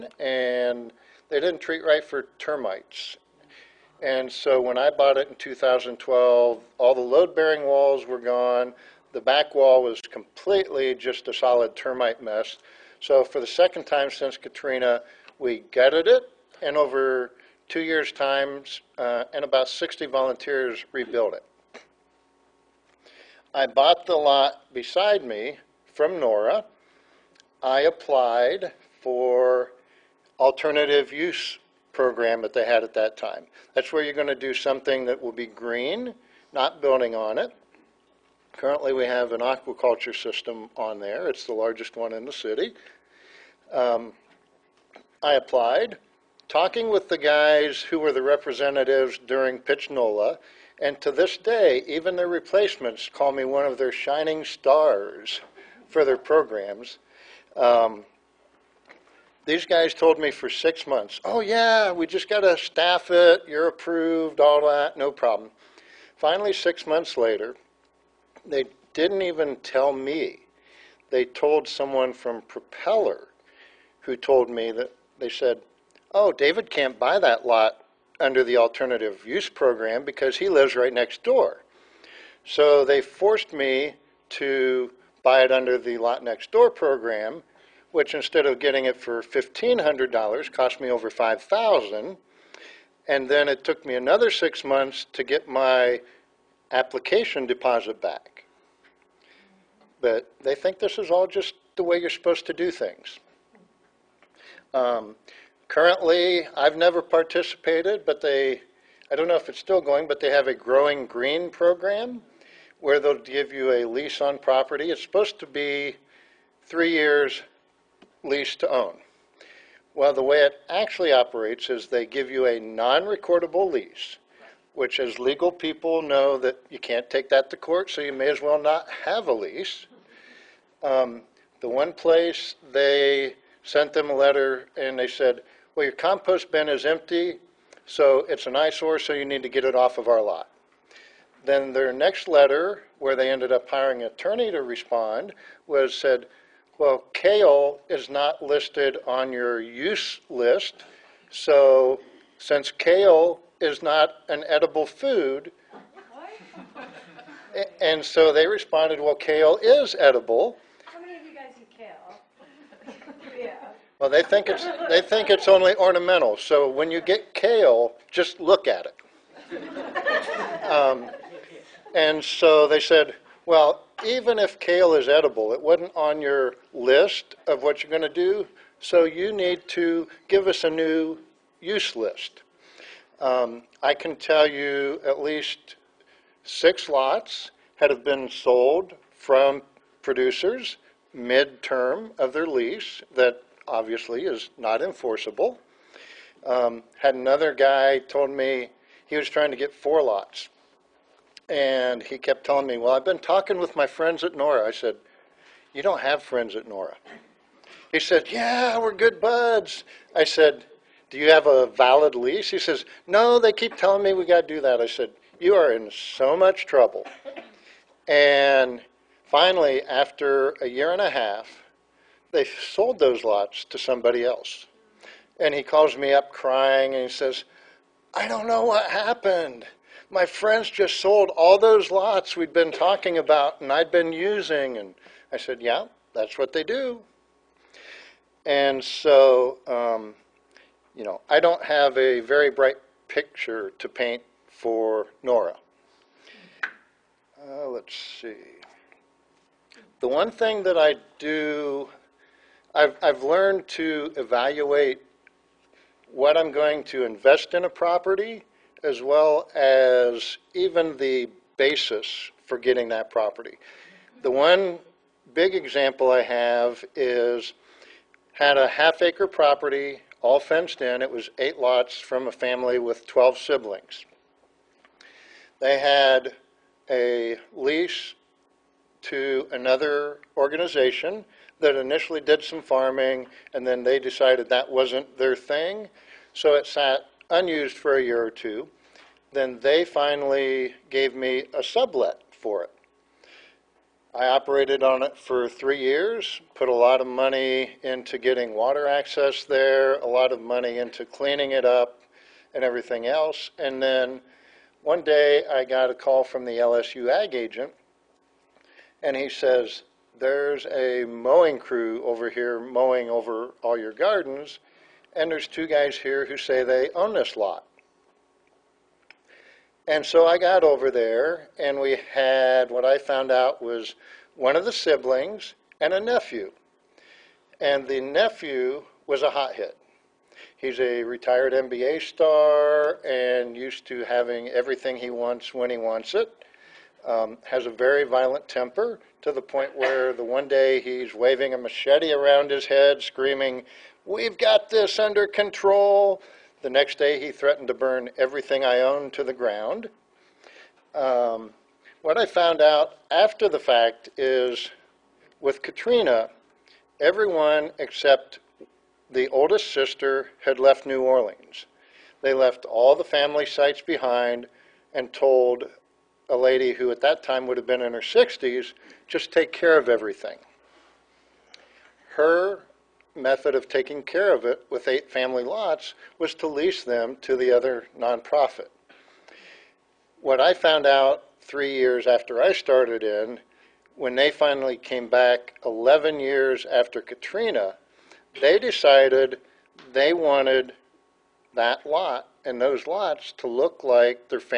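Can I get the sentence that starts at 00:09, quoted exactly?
The back wall was completely just a solid termite mess.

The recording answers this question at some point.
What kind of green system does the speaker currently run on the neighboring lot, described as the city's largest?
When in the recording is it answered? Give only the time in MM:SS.
00:39.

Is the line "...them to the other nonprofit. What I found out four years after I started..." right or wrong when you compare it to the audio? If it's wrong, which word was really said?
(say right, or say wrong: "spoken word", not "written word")
wrong: "three", not "four".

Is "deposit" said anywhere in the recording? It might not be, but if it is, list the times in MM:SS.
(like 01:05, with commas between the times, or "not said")
01:37.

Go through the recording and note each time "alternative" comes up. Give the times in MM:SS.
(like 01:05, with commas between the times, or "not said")
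00:30, 01:18.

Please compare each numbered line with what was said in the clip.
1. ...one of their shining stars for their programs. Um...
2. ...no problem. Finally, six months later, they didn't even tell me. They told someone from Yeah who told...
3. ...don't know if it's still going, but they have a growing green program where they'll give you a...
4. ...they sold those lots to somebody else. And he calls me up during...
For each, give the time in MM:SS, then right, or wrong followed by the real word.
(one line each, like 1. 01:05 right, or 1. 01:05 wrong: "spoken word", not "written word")
1. 00:53 right
2. 01:04 wrong: "Propeller", not "Yeah"
3. 01:49 right
4. 03:42 wrong: "crying", not "during".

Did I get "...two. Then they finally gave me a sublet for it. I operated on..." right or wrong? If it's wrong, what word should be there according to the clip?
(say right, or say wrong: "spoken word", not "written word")
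right.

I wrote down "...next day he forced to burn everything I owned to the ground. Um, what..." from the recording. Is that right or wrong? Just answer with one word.
wrong.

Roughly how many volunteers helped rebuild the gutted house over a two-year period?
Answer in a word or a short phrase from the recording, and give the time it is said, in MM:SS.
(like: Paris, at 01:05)
60, at 00:19.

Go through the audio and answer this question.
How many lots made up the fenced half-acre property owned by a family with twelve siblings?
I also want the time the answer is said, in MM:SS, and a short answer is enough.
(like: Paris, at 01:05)
8, at 04:31.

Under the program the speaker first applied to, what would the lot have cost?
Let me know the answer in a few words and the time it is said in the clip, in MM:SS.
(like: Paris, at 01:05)
$1,500, at 01:29.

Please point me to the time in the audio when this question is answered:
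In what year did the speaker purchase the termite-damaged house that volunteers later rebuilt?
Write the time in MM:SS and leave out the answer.
00:05.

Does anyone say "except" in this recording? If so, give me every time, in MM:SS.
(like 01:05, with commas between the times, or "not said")
05:57.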